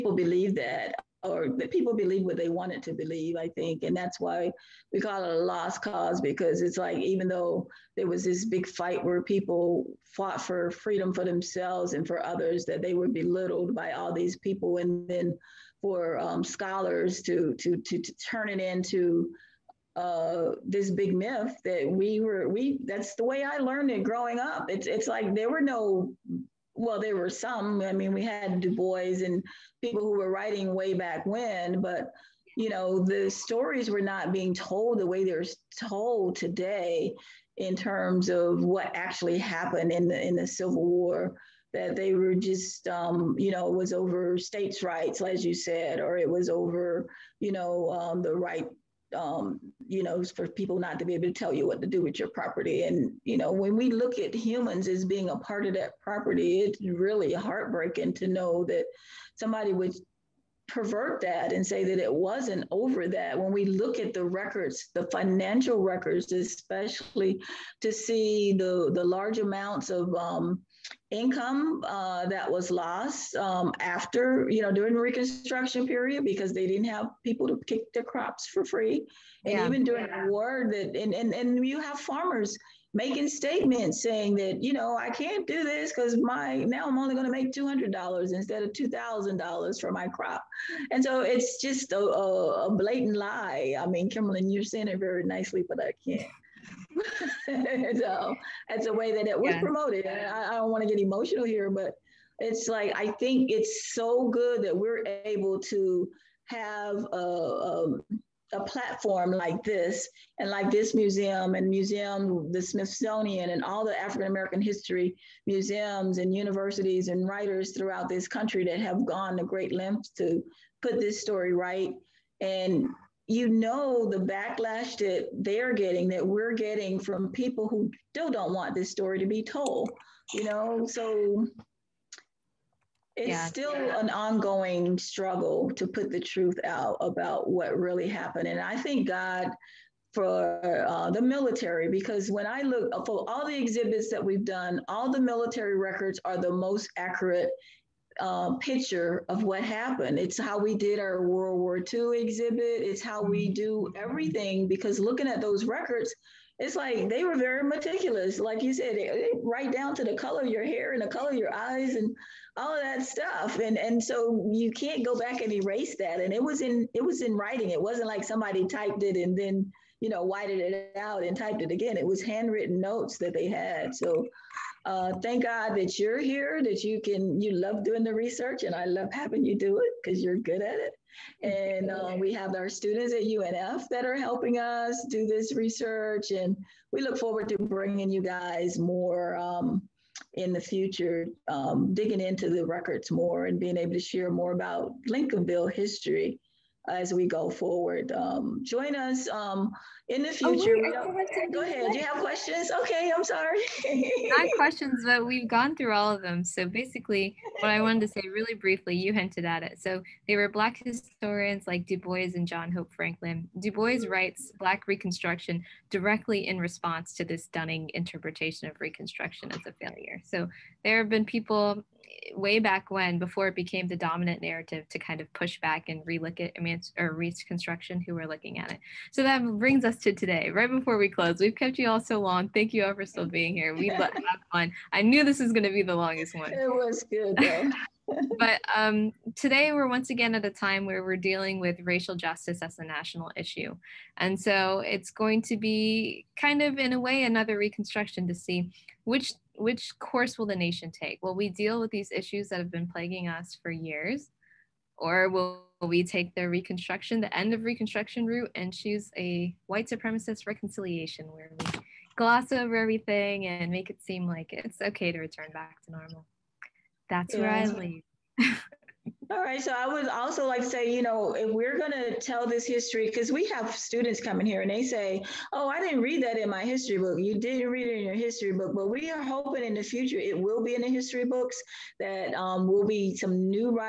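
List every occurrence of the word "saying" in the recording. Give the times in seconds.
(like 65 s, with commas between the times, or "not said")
84 s, 94 s.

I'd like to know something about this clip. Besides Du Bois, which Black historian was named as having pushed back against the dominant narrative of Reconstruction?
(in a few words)
John Hope Franklin.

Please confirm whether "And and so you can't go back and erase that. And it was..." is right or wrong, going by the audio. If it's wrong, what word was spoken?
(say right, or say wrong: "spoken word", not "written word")
right.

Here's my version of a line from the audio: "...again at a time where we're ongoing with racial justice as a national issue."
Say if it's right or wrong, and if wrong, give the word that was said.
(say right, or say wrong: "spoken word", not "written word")
wrong: "dealing", not "ongoing".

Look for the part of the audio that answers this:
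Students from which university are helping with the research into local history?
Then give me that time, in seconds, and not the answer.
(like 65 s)
183 s.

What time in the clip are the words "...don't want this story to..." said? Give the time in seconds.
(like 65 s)
128 s.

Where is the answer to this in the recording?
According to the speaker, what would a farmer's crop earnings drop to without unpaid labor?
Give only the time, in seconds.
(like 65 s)
87 s.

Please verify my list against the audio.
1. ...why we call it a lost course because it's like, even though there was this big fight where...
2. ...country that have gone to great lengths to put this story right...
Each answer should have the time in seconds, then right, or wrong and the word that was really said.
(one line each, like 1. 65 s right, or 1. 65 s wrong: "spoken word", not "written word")
1. 4 s wrong: "cause", not "course"
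2. 118 s right.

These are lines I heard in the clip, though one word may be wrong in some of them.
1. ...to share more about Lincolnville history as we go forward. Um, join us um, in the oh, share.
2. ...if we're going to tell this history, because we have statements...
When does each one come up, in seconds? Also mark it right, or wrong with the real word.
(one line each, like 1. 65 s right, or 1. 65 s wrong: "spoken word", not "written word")
1. 193 s wrong: "future", not "share"
2. 271 s wrong: "students", not "statements".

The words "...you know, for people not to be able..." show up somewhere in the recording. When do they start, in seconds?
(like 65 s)
49 s.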